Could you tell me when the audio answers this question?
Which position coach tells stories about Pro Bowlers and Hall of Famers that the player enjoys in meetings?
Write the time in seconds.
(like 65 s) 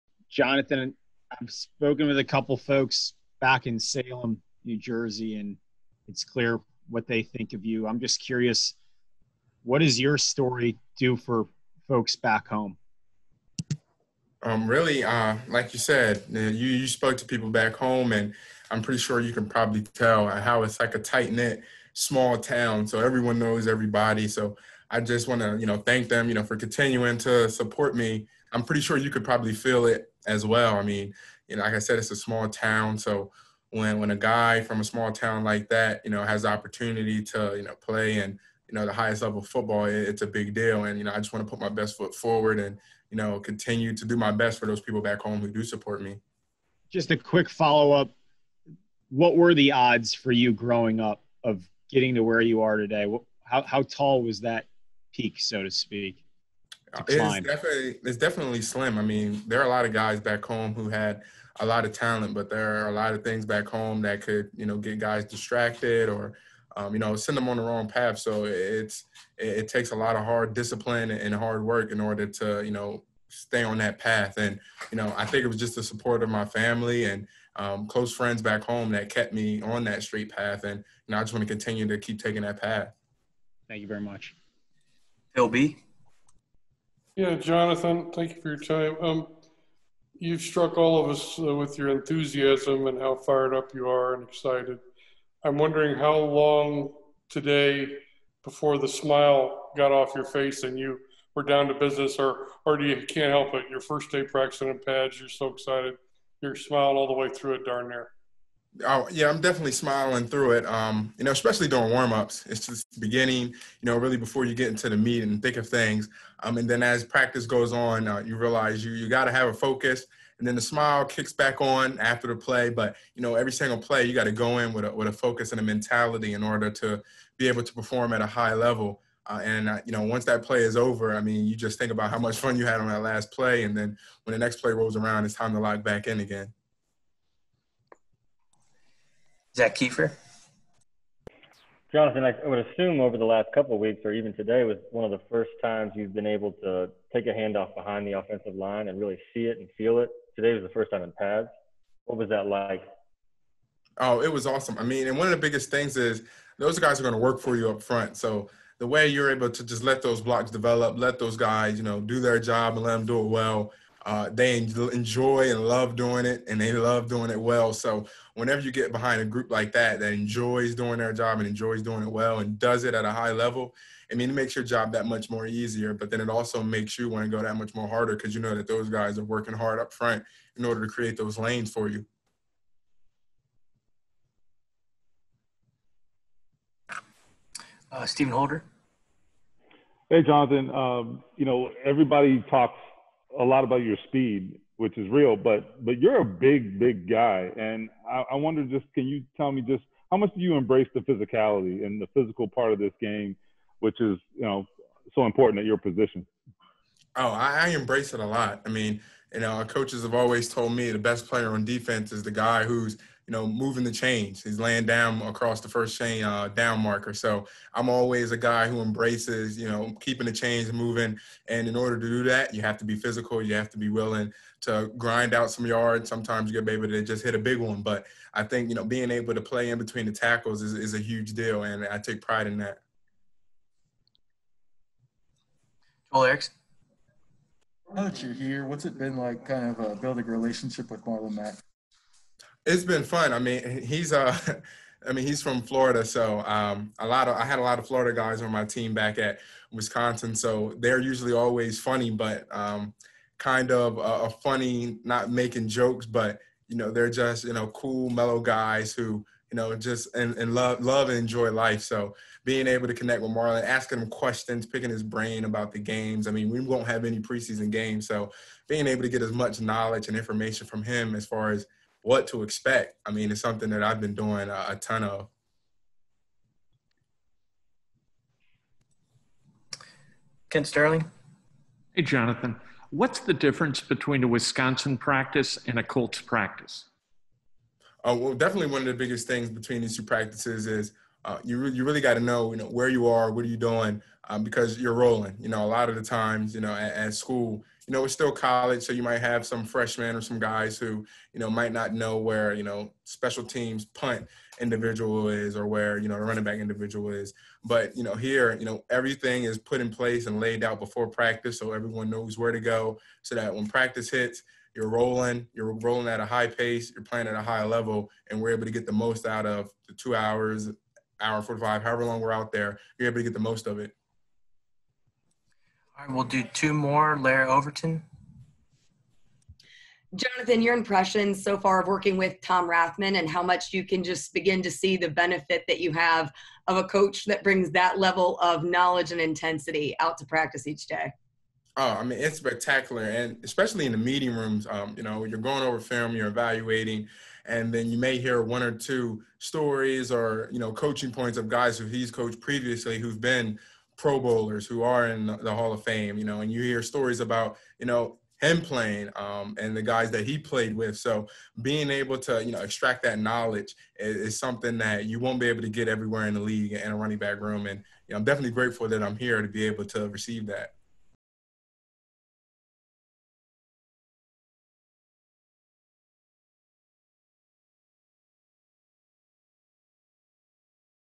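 332 s.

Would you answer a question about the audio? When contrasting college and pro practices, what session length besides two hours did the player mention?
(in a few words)
1 hour 45.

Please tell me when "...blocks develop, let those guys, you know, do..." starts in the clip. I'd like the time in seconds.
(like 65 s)
160 s.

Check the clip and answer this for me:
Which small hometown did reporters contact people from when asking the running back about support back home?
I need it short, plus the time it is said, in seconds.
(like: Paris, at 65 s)
Salem, New Jersey, at 3 s.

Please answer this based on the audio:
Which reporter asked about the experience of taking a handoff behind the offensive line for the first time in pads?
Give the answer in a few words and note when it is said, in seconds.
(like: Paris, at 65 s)
Zak Keefer, at 139 s.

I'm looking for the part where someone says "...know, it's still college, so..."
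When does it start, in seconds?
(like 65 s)
297 s.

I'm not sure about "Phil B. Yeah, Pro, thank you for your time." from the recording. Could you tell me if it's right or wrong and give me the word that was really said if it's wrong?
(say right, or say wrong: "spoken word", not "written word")
wrong: "Jonathan", not "Pro".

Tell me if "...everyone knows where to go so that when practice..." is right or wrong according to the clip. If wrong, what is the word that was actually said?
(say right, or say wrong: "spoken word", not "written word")
right.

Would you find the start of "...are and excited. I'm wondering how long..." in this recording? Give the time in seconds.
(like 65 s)
93 s.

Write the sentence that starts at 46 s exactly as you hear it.
Just a quick follow up: What were the odds for you growing up of getting to where you are today?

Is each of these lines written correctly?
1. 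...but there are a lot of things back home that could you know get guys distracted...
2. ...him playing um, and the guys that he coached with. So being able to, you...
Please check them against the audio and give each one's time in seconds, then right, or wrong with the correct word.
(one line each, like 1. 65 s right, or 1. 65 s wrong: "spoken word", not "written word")
1. 62 s right
2. 358 s wrong: "played", not "coached".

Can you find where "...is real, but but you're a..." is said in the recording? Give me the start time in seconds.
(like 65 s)
194 s.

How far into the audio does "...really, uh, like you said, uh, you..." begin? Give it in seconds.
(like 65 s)
14 s.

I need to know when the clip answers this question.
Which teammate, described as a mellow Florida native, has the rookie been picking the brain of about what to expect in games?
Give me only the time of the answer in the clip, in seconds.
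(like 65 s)
241 s.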